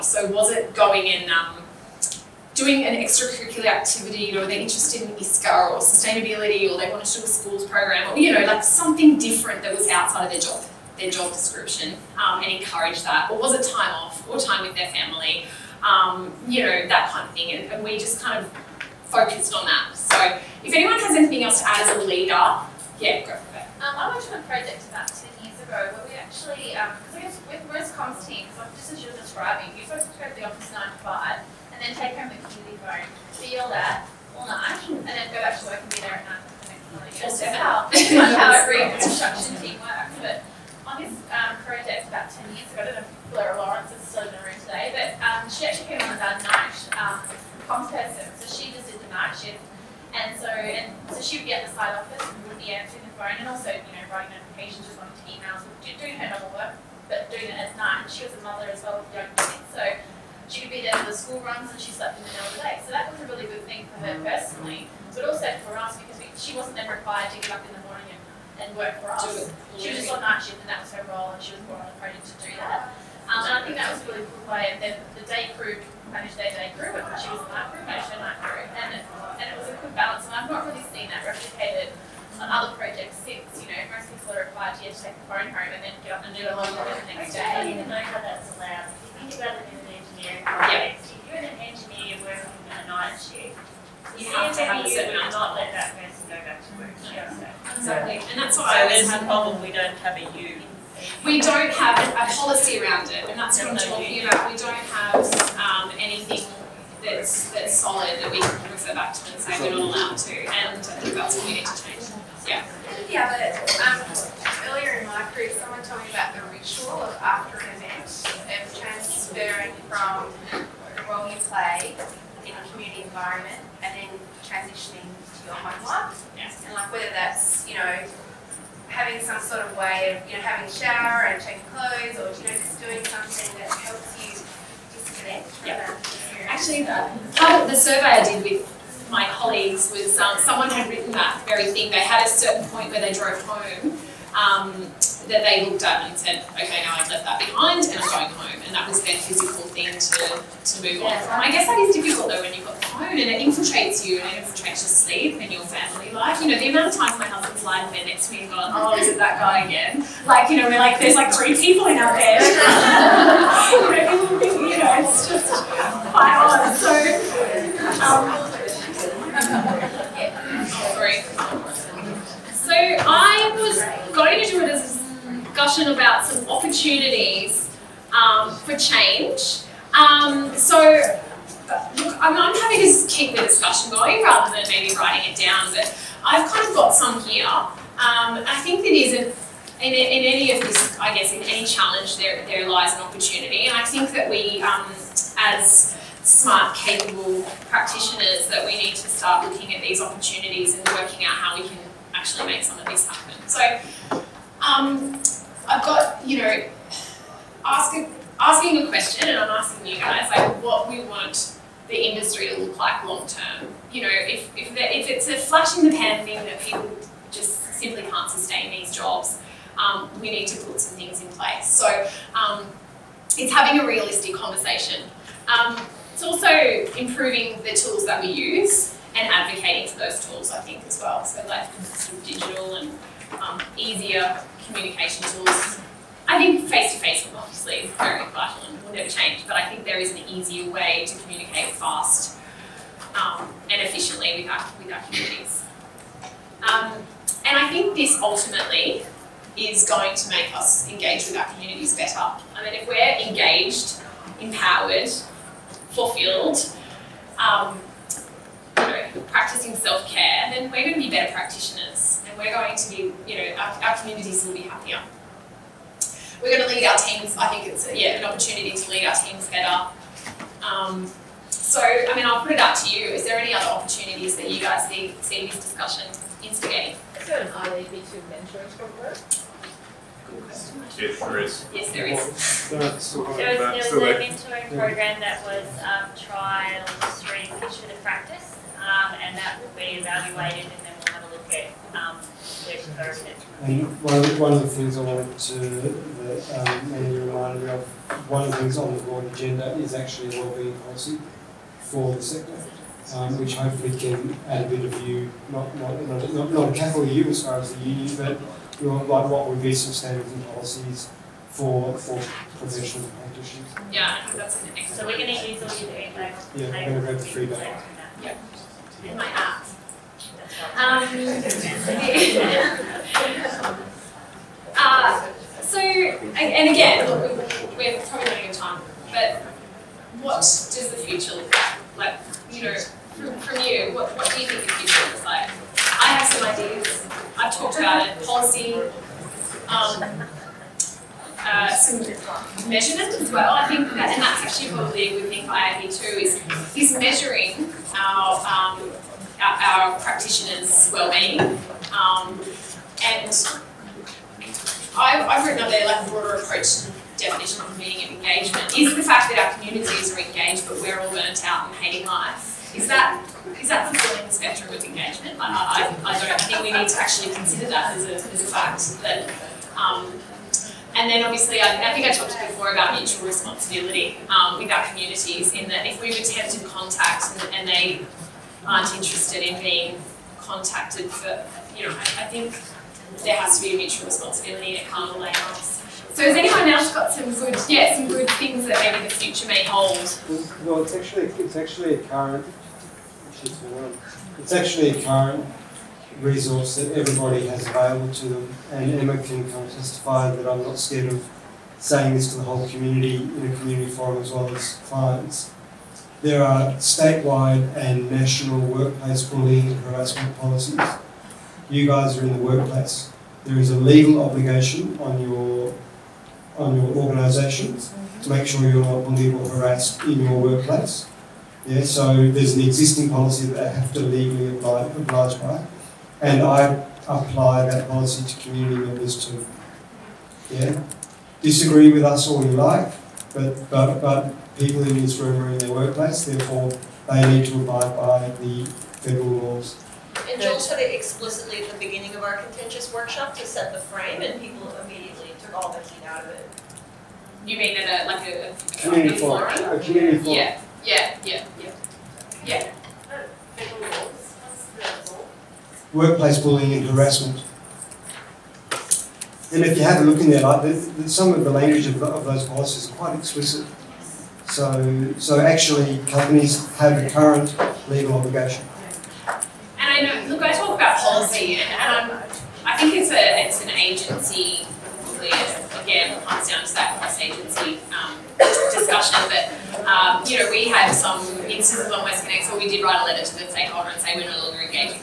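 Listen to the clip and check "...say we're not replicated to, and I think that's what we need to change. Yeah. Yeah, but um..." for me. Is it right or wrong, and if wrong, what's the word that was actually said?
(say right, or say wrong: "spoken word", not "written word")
wrong: "allowed", not "replicated".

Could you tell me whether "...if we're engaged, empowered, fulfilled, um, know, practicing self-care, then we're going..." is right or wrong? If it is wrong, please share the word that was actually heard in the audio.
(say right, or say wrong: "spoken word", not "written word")
right.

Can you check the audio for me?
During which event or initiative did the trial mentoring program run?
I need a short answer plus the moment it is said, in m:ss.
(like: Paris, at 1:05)
Picture to Practice, at 4:47.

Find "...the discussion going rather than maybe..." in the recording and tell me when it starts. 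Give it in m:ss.
3:03.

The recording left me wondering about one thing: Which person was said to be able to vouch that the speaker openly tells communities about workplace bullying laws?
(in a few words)
Emma.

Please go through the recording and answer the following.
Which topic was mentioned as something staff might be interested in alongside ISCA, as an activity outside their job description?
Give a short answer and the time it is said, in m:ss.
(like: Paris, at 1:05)
Sustainability, at 0:05.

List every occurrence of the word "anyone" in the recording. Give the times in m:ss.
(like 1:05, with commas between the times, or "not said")
0:20, 6:26.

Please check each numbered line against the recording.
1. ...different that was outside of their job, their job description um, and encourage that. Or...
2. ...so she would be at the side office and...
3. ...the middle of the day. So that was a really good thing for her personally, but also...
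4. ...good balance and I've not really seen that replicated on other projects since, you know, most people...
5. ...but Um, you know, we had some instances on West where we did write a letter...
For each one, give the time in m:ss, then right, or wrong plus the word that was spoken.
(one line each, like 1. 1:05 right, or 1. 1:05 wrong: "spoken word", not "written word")
1. 0:09 right
2. 0:51 right
3. 1:02 right
4. 1:19 right
5. 7:59 right.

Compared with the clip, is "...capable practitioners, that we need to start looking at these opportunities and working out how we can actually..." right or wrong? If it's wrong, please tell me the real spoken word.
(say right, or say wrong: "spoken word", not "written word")
right.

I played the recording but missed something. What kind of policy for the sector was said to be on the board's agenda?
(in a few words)
A wellbeing policy.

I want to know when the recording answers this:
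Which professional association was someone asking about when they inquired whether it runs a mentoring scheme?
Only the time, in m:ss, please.
4:37.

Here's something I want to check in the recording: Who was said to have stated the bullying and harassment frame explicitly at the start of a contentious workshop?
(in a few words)
Joel.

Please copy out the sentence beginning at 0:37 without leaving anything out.
That's how, how every construction team works.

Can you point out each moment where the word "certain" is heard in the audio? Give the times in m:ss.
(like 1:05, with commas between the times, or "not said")
1:34, 2:22.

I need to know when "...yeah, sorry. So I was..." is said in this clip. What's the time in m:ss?
2:50.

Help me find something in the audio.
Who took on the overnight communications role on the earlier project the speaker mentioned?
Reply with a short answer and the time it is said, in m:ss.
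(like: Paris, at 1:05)
Laura Lawrence, at 0:43.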